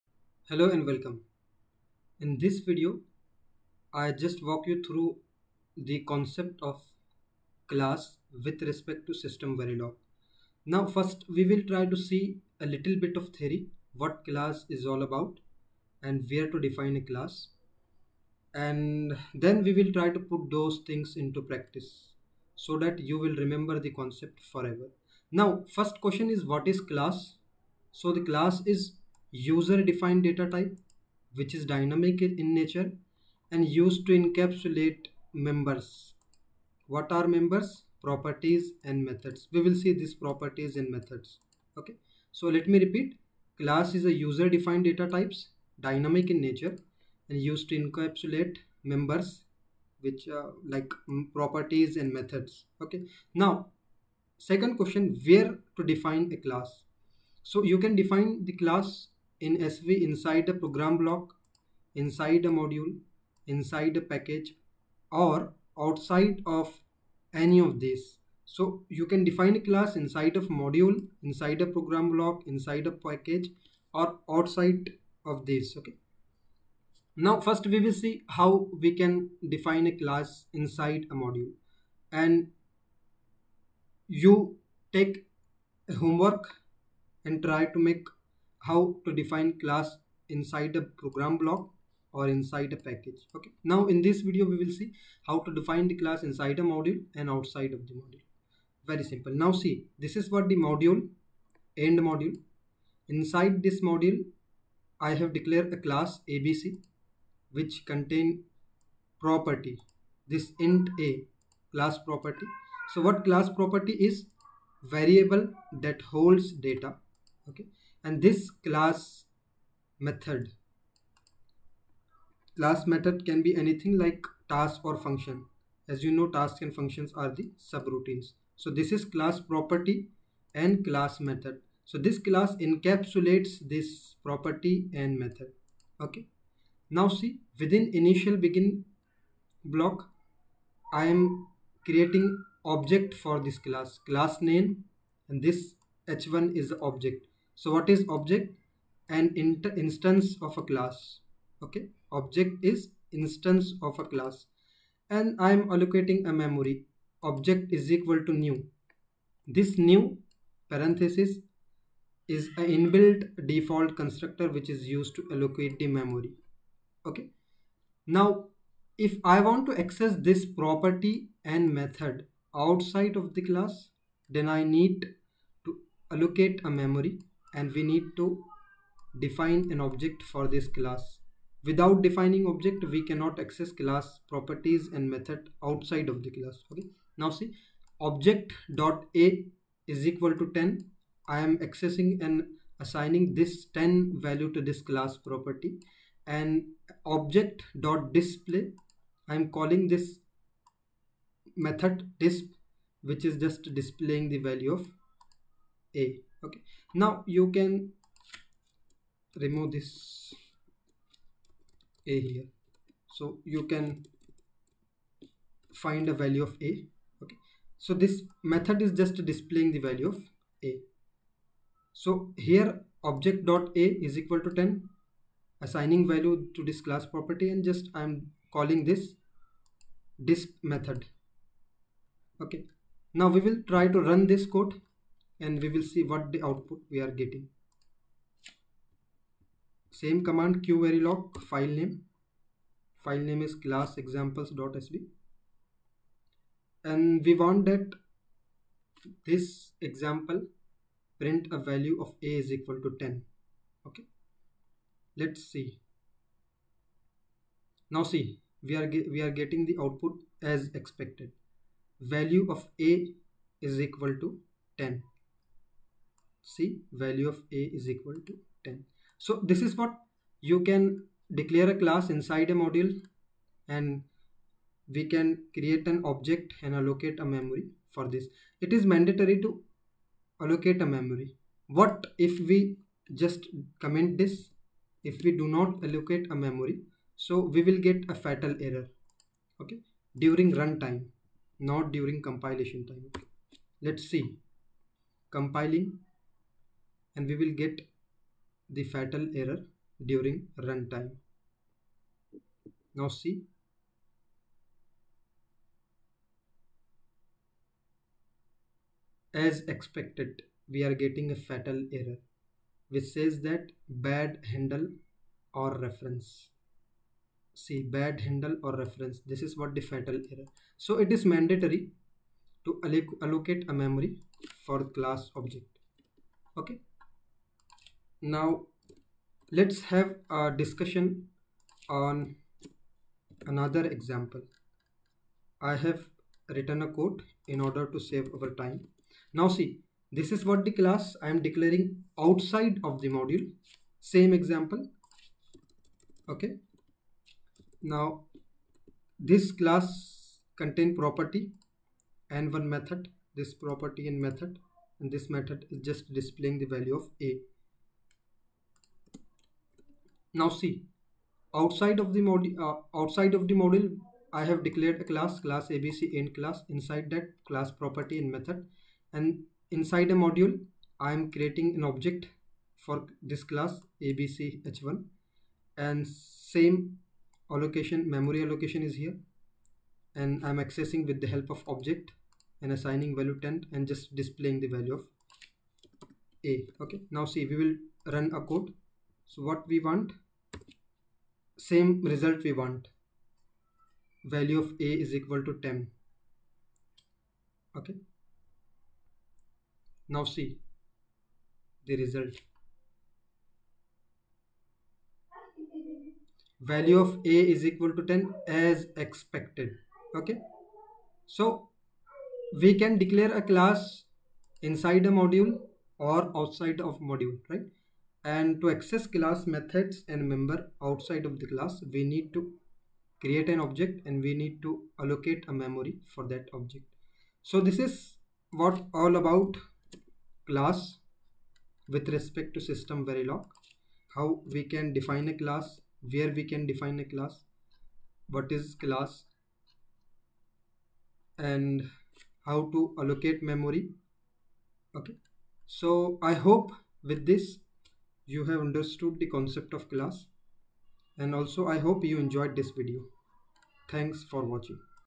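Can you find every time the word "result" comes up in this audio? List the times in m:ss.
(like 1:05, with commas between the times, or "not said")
6:32, 6:42.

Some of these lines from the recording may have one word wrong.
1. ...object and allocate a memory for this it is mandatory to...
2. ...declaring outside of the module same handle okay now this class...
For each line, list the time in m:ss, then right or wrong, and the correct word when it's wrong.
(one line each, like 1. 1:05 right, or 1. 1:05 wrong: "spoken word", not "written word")
1. 4:36 right
2. 5:41 wrong: "example", not "handle".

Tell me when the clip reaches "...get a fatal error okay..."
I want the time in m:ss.
4:47.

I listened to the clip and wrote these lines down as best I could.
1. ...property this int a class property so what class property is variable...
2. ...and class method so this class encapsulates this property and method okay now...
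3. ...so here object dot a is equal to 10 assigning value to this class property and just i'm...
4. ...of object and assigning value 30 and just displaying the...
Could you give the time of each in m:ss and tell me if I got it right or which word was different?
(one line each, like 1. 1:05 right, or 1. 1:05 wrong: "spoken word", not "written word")
1. 1:49 right
2. 2:10 right
3. 3:41 right
4. 6:21 wrong: "10", not "30".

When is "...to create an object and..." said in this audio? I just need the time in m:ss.
7:02.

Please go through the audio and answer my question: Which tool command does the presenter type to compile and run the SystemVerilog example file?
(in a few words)
qverilog.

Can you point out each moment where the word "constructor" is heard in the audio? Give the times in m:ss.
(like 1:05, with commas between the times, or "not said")
2:43.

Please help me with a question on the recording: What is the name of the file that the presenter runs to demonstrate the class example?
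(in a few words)
class examples.sv.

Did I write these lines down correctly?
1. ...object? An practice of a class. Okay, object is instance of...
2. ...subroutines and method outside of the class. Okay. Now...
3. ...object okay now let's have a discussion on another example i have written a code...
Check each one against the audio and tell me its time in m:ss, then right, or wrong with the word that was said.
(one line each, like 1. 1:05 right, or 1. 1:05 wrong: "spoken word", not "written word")
1. 2:28 wrong: "instance", not "practice"
2. 3:04 wrong: "properties", not "subroutines"
3. 5:25 right.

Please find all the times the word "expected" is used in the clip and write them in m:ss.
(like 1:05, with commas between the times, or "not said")
4:20, 5:09, 6:49.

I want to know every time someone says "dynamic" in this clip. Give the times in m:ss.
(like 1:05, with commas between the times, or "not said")
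0:31, 0:45.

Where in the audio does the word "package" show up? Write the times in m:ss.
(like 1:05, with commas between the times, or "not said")
1:04, 1:12, 1:32.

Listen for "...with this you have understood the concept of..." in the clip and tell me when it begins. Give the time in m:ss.
7:27.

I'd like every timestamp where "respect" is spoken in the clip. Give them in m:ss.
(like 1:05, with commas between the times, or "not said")
0:08, 7:12.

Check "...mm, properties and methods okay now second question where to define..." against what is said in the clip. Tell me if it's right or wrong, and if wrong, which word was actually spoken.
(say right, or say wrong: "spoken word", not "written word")
right.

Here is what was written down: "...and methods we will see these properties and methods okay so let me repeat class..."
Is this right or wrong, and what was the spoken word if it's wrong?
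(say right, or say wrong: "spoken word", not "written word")
right.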